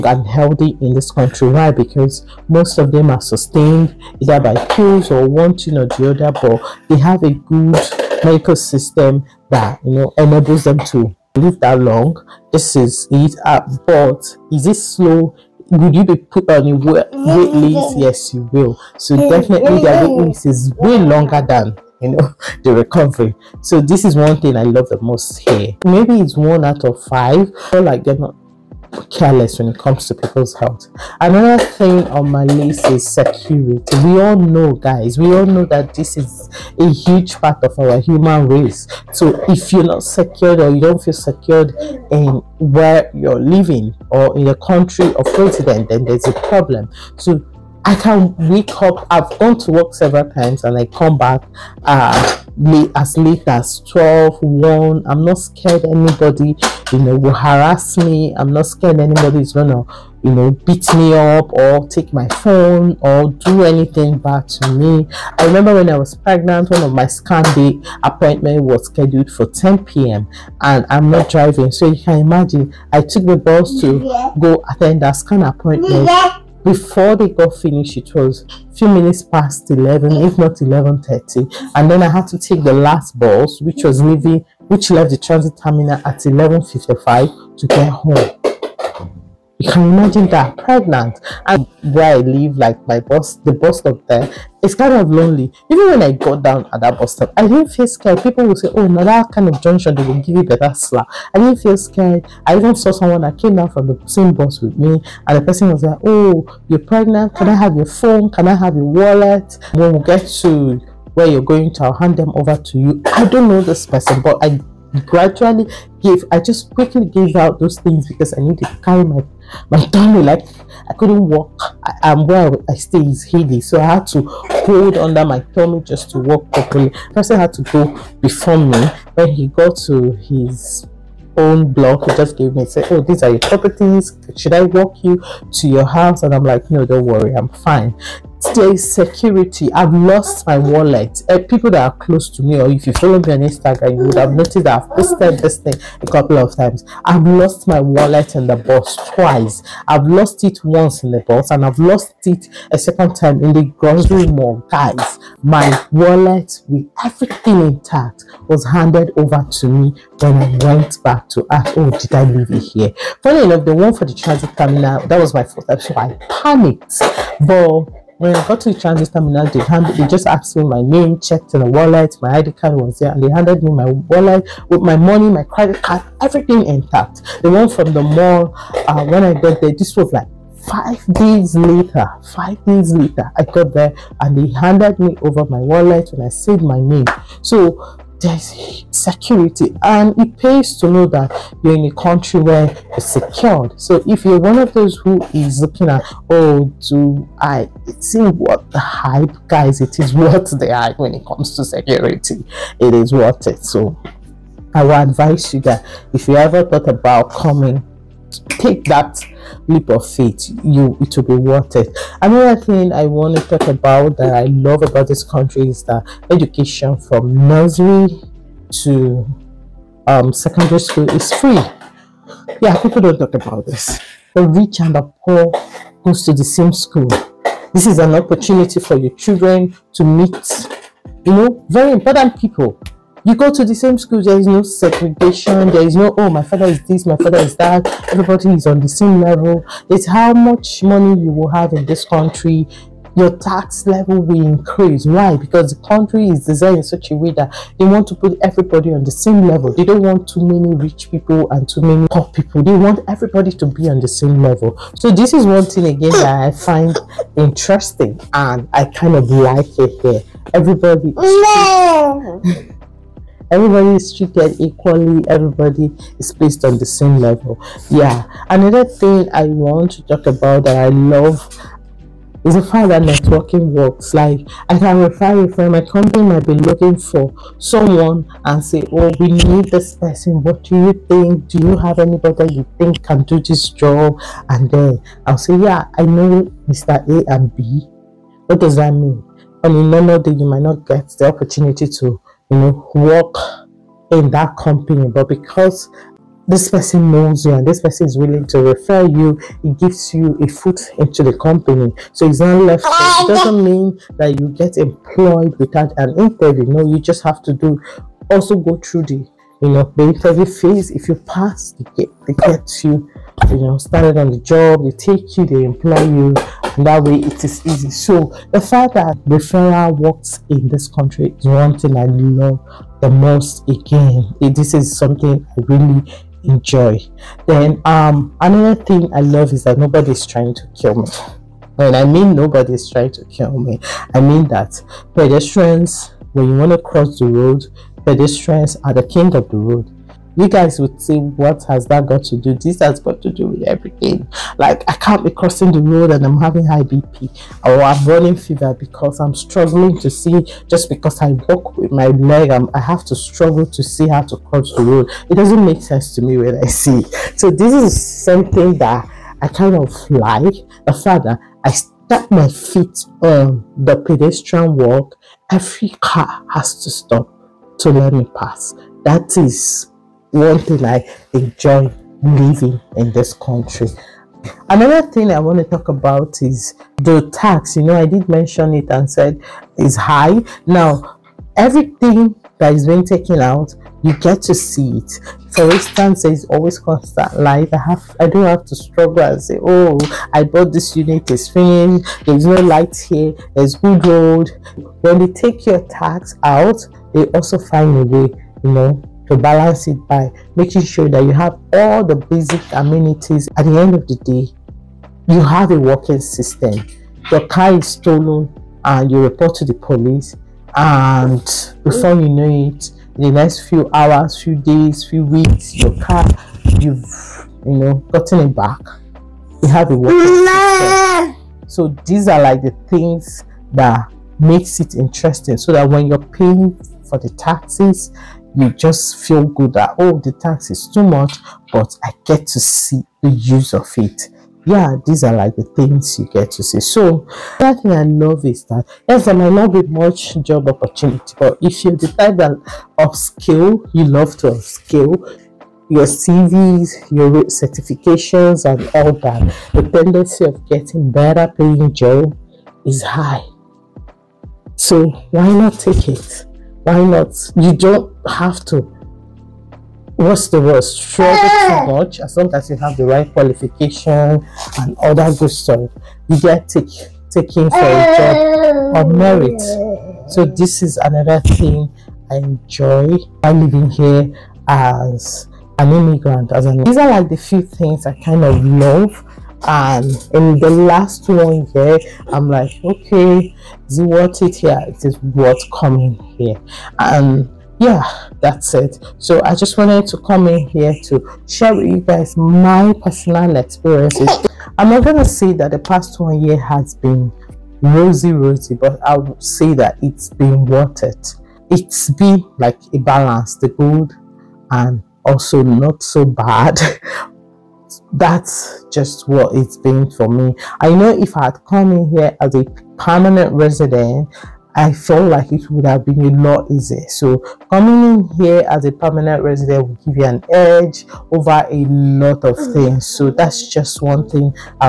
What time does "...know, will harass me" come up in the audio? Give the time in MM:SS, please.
00:56.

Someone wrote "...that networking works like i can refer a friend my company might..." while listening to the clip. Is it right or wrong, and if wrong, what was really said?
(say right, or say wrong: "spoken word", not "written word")
right.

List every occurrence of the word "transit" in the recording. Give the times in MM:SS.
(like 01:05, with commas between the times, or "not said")
01:25, 02:44, 02:48.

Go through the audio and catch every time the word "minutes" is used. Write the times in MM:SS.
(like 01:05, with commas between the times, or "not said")
01:18.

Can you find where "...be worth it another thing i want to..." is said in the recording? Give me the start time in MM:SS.
03:31.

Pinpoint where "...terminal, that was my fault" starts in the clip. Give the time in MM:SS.
02:44.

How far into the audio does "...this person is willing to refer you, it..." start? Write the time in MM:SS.
04:57.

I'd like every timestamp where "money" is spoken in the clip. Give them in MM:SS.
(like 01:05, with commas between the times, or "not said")
02:54, 04:00.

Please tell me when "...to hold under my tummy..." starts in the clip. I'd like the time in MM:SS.
02:04.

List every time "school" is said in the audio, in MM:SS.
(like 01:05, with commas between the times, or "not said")
03:40, 03:46, 03:53.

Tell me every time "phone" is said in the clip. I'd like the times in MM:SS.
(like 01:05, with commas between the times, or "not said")
01:02, 01:47.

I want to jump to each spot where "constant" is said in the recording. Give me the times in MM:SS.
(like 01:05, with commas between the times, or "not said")
06:26.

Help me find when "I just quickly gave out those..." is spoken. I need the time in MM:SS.
01:56.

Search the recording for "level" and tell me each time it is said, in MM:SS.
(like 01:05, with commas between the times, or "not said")
03:59, 04:03, 04:09, 04:14, 04:27.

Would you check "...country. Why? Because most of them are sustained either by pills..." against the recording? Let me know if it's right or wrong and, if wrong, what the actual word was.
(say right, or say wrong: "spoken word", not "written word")
right.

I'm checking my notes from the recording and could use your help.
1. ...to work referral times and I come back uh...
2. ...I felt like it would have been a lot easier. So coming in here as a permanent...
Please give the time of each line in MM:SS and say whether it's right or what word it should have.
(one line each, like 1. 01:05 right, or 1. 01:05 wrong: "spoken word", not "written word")
1. 00:49 wrong: "several", not "referral"
2. 08:34 right.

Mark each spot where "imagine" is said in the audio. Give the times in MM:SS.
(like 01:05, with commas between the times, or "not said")
01:12, 01:29.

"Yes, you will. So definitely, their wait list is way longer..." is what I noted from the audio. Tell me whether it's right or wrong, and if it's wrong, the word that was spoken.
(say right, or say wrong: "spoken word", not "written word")
right.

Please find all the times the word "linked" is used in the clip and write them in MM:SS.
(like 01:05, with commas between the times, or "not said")
not said.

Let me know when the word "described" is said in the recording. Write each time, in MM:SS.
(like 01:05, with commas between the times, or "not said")
not said.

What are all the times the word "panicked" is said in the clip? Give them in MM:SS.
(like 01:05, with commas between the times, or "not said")
02:46.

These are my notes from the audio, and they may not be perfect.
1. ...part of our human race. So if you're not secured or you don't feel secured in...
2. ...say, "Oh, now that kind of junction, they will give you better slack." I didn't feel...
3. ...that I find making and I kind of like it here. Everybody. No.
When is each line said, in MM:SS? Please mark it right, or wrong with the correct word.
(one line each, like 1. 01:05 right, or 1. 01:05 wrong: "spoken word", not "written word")
1. 00:37 right
2. 01:38 right
3. 04:16 wrong: "interesting", not "making".